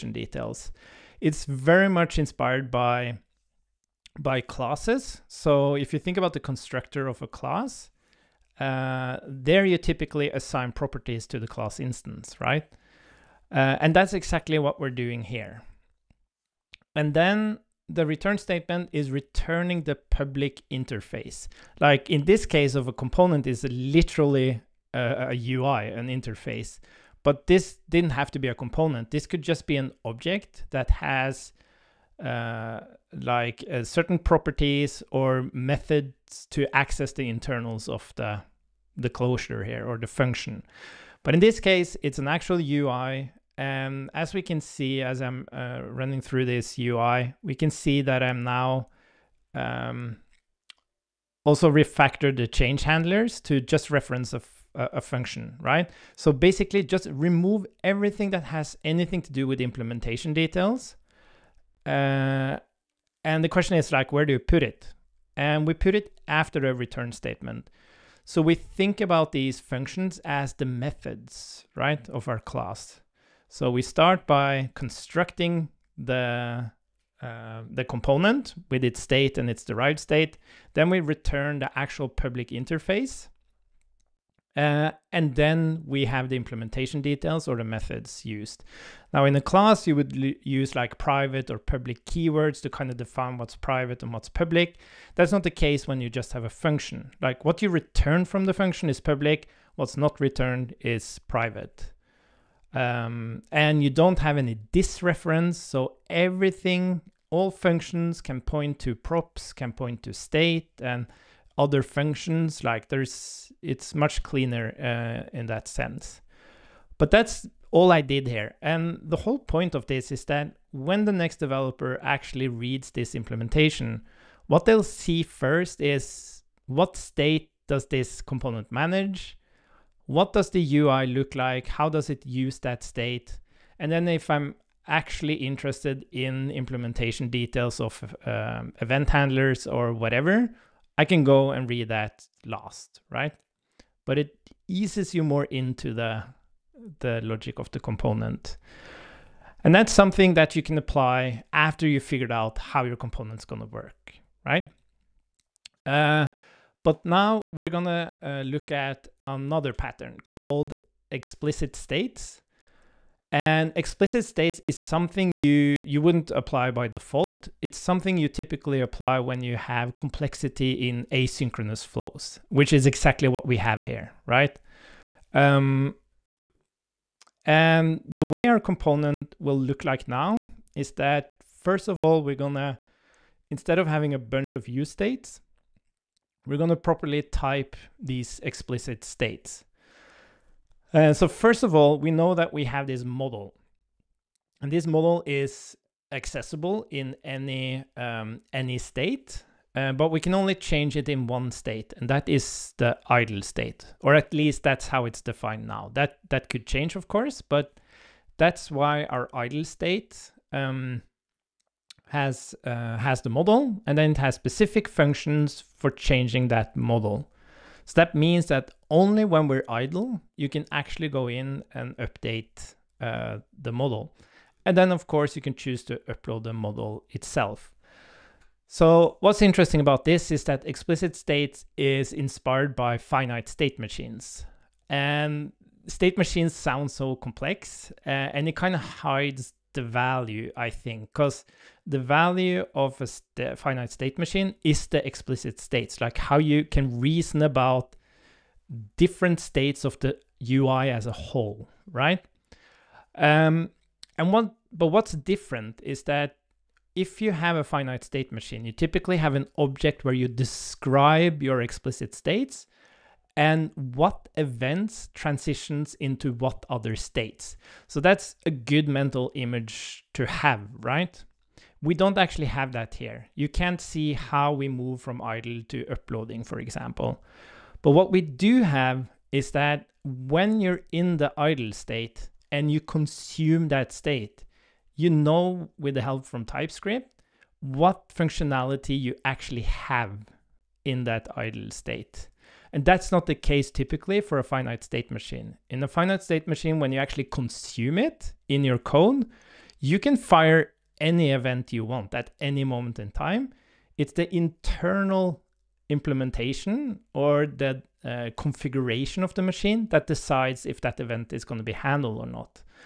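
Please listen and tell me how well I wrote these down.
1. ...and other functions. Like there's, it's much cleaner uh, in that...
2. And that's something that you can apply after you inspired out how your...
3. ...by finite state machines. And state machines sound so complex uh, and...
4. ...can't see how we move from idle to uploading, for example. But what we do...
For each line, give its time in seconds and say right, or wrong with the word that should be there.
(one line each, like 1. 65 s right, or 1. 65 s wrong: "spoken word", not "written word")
1. 110 s right
2. 149 s wrong: "figured", not "inspired"
3. 232 s right
4. 273 s right.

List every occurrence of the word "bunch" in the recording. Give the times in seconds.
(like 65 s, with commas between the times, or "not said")
184 s.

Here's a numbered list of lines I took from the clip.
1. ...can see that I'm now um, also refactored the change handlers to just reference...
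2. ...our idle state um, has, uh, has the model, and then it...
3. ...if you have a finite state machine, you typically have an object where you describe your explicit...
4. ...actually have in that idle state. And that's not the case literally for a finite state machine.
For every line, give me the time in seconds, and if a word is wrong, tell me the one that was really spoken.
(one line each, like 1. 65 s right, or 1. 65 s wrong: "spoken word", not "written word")
1. 47 s right
2. 209 s right
3. 256 s right
4. 289 s wrong: "typically", not "literally".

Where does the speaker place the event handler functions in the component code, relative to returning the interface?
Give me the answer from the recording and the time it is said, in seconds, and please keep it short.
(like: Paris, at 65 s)
After a return statement, at 66 s.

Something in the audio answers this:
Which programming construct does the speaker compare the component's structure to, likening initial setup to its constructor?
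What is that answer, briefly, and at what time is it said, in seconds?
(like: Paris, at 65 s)
Classes, at 4 s.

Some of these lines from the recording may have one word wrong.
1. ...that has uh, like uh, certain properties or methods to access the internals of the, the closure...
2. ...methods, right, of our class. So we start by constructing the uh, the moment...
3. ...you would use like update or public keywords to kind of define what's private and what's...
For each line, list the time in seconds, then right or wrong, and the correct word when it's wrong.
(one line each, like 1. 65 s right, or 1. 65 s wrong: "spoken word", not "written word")
1. 30 s right
2. 70 s wrong: "component", not "moment"
3. 89 s wrong: "private", not "update".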